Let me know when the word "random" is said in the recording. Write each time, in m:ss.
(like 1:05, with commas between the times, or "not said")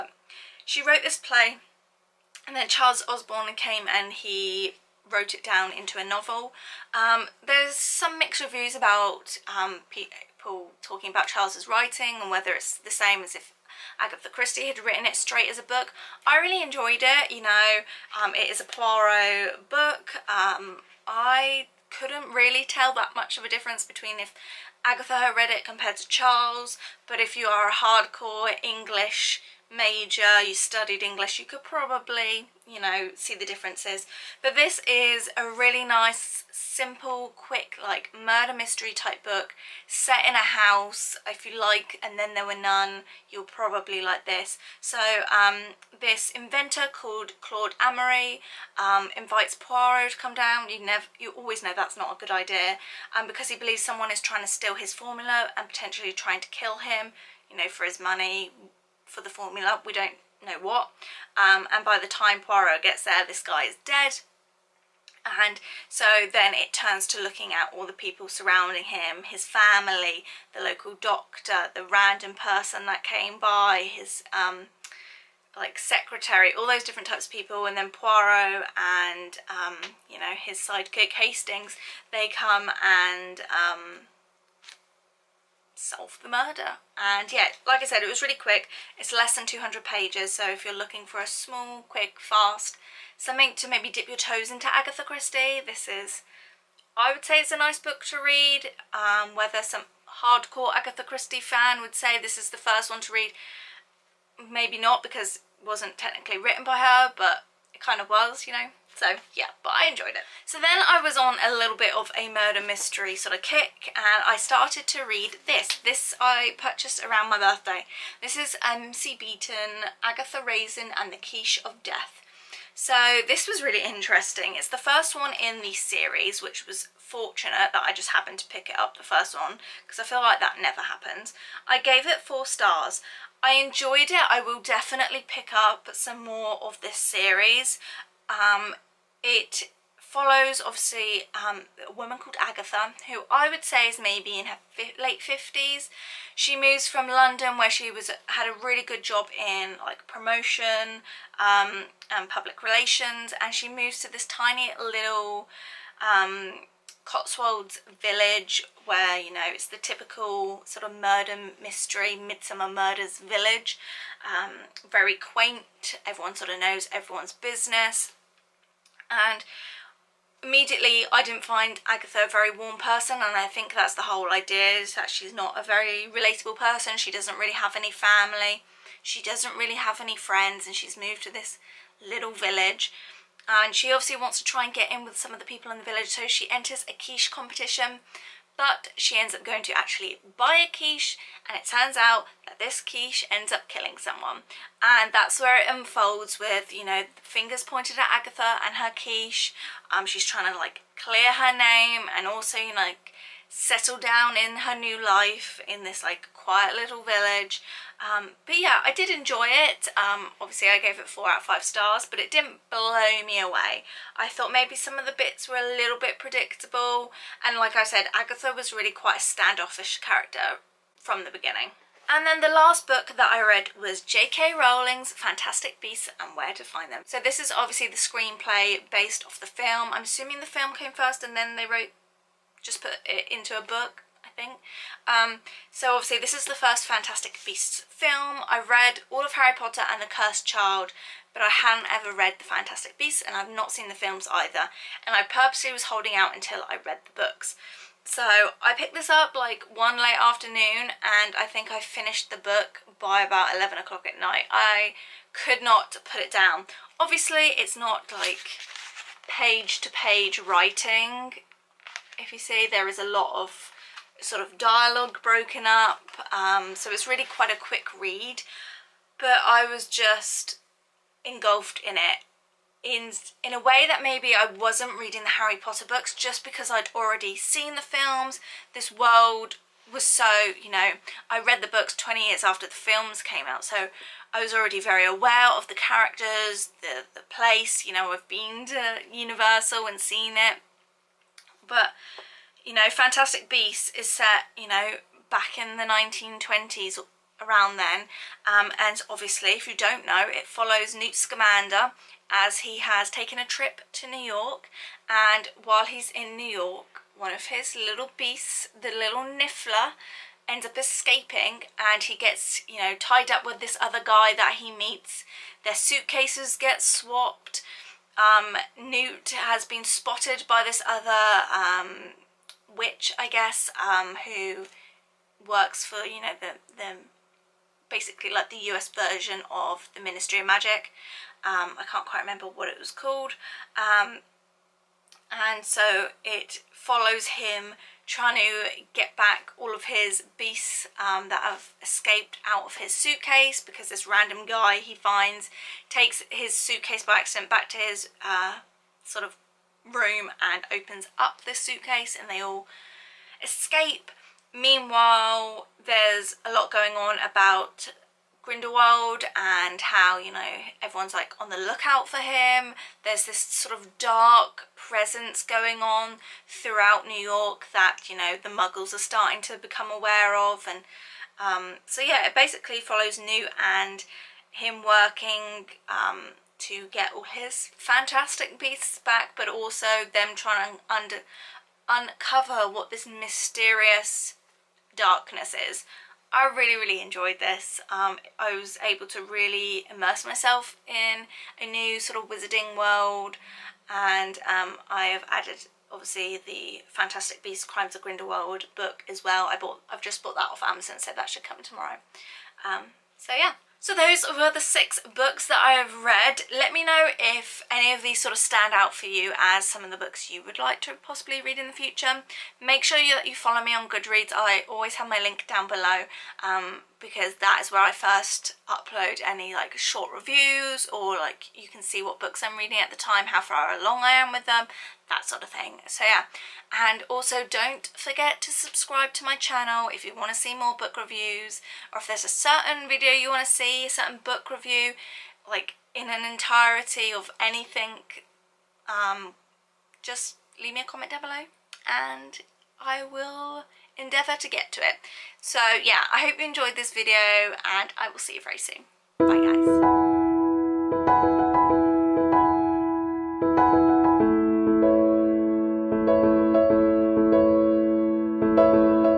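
1:11, 5:44.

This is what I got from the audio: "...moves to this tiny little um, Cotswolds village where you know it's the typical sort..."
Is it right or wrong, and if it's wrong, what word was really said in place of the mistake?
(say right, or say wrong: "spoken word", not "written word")
right.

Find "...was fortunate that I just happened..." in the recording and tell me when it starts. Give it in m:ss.
2:06.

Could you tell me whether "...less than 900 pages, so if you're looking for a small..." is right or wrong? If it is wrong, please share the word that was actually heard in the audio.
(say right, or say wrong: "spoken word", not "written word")
wrong: "200", not "900".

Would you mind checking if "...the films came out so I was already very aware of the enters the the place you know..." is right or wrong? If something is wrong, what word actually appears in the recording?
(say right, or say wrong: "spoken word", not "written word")
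wrong: "characters", not "enters".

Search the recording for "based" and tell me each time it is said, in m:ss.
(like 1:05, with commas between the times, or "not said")
3:48.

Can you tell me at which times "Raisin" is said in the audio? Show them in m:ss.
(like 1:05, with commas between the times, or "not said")
2:00.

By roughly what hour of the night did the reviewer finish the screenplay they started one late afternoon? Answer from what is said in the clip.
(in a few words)
11 o'clock.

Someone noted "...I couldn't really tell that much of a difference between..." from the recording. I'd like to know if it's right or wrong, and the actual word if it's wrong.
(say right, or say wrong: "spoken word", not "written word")
right.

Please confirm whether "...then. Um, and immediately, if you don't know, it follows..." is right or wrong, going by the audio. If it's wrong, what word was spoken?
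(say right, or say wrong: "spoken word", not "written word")
wrong: "obviously", not "immediately".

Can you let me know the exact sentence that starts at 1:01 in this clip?
Um, and by the time Poirot gets there, this guy is dead.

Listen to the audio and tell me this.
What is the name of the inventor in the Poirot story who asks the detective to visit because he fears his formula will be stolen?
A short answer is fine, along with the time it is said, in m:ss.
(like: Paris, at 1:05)
Claude Amory, at 0:47.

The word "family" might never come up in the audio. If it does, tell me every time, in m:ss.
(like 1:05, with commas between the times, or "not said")
1:09, 2:57.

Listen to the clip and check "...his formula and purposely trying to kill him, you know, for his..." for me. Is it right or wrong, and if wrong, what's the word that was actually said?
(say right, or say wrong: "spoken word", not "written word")
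wrong: "potentially", not "purposely".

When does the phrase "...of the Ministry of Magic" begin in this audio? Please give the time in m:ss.
5:29.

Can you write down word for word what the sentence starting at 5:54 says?
Meanwhile, there's a lot going on about Grindelwald and how, you know, everyone's like on the lookout for him.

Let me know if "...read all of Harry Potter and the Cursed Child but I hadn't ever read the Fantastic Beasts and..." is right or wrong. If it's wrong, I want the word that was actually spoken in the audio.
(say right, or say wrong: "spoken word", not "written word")
right.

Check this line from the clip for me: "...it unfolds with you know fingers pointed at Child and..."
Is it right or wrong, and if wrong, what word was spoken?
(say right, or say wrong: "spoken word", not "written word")
wrong: "Agatha", not "Child".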